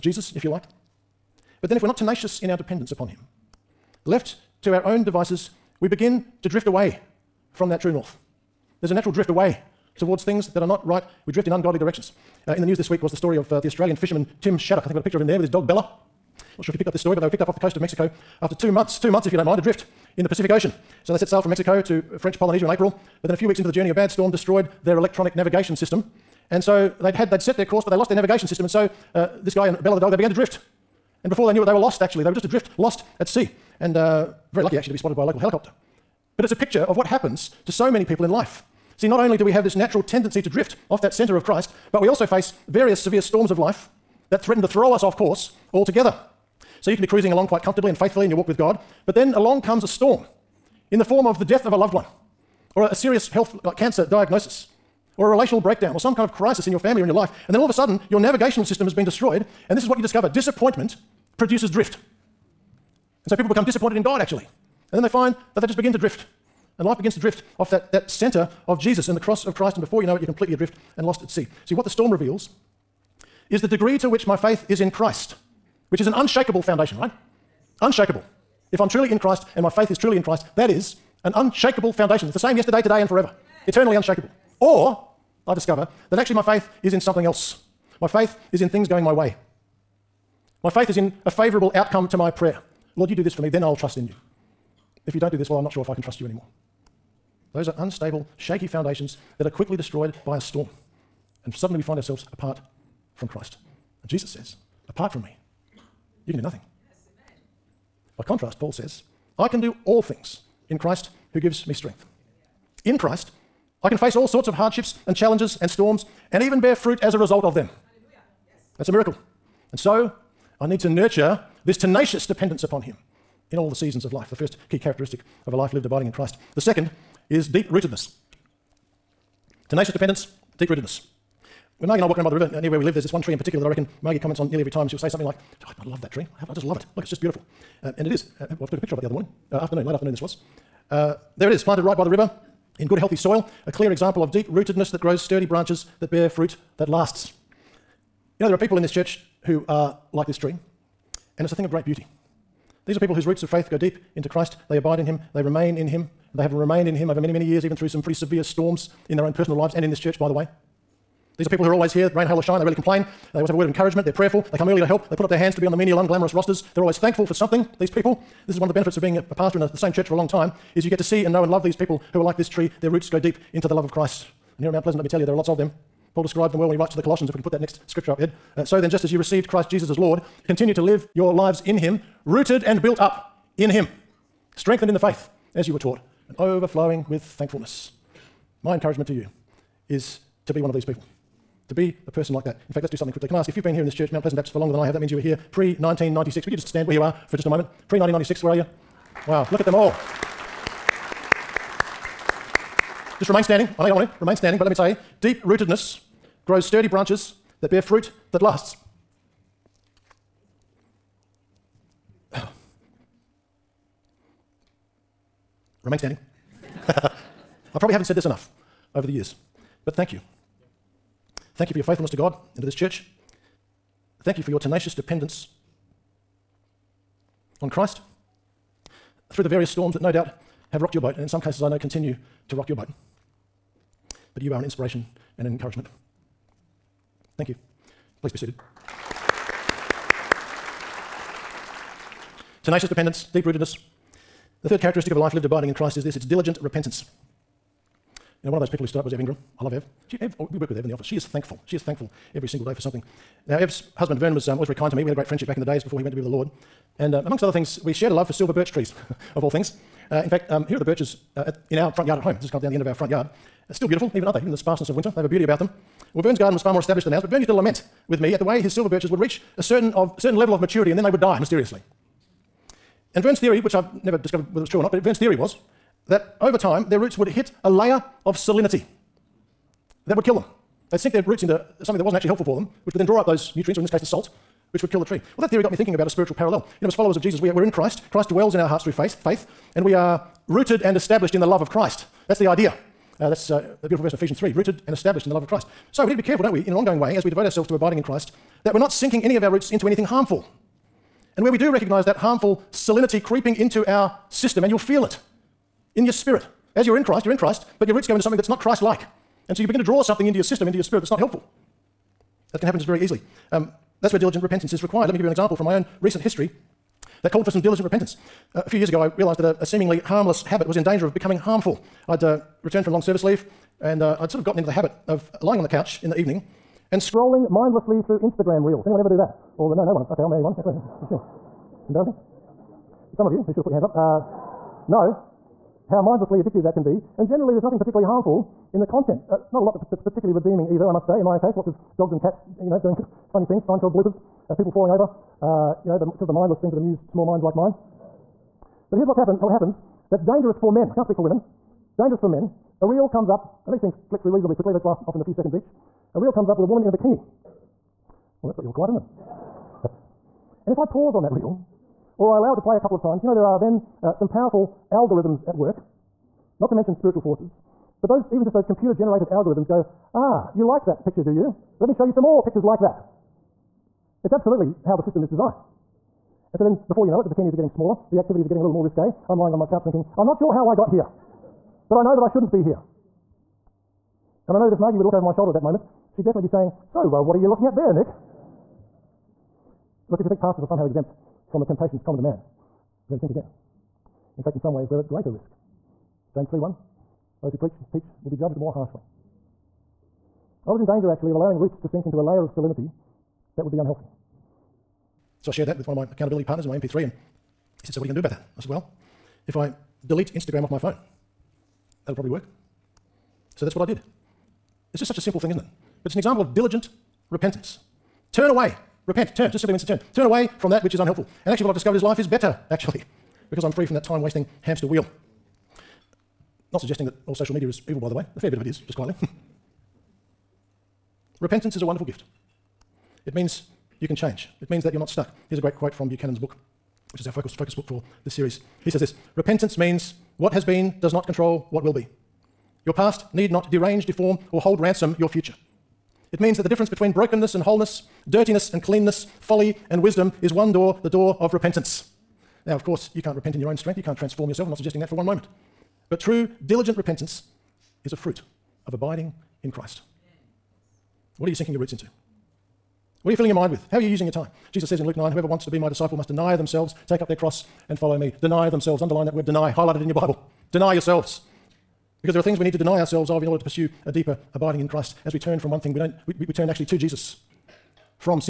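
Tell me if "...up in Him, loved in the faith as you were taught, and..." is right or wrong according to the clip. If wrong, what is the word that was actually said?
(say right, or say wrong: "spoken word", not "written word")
wrong: "strengthened", not "loved".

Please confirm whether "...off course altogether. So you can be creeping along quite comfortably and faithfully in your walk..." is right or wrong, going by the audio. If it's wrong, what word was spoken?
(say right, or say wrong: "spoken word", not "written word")
wrong: "cruising", not "creeping".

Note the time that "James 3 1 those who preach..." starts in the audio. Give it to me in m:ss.
6:36.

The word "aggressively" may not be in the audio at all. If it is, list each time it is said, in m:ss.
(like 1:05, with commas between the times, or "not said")
not said.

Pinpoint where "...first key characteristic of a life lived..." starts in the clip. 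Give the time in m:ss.
2:04.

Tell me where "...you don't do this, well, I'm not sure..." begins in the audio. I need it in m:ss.
1:35.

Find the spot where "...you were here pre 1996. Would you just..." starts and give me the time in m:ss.
3:15.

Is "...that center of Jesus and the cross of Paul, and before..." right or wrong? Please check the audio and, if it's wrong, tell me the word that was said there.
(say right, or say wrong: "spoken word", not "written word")
wrong: "Christ", not "Paul".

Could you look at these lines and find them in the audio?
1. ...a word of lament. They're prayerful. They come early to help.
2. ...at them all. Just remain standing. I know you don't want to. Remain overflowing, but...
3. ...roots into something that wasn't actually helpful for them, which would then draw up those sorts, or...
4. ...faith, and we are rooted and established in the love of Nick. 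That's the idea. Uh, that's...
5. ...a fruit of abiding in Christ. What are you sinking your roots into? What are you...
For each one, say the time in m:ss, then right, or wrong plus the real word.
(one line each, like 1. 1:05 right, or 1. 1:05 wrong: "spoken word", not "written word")
1. 2:43 wrong: "encouragement", not "lament"
2. 3:19 wrong: "standing", not "overflowing"
3. 4:41 wrong: "nutrients", not "sorts"
4. 4:49 wrong: "Christ", not "Nick"
5. 7:38 right.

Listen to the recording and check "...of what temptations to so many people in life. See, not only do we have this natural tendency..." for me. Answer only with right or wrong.
wrong.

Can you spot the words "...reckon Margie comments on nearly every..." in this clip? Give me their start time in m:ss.
2:13.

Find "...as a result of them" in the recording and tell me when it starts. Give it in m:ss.
1:57.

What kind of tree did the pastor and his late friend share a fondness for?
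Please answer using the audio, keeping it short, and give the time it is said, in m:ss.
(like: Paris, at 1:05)
Silver birch, at 4:18.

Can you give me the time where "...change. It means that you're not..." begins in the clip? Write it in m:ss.
7:14.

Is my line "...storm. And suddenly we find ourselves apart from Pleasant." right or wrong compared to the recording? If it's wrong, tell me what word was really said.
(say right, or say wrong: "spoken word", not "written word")
wrong: "Christ", not "Pleasant".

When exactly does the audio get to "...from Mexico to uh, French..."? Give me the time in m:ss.
0:21.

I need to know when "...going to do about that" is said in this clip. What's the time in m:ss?
6:48.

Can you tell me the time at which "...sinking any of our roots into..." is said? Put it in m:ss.
4:58.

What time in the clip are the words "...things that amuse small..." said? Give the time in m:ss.
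5:46.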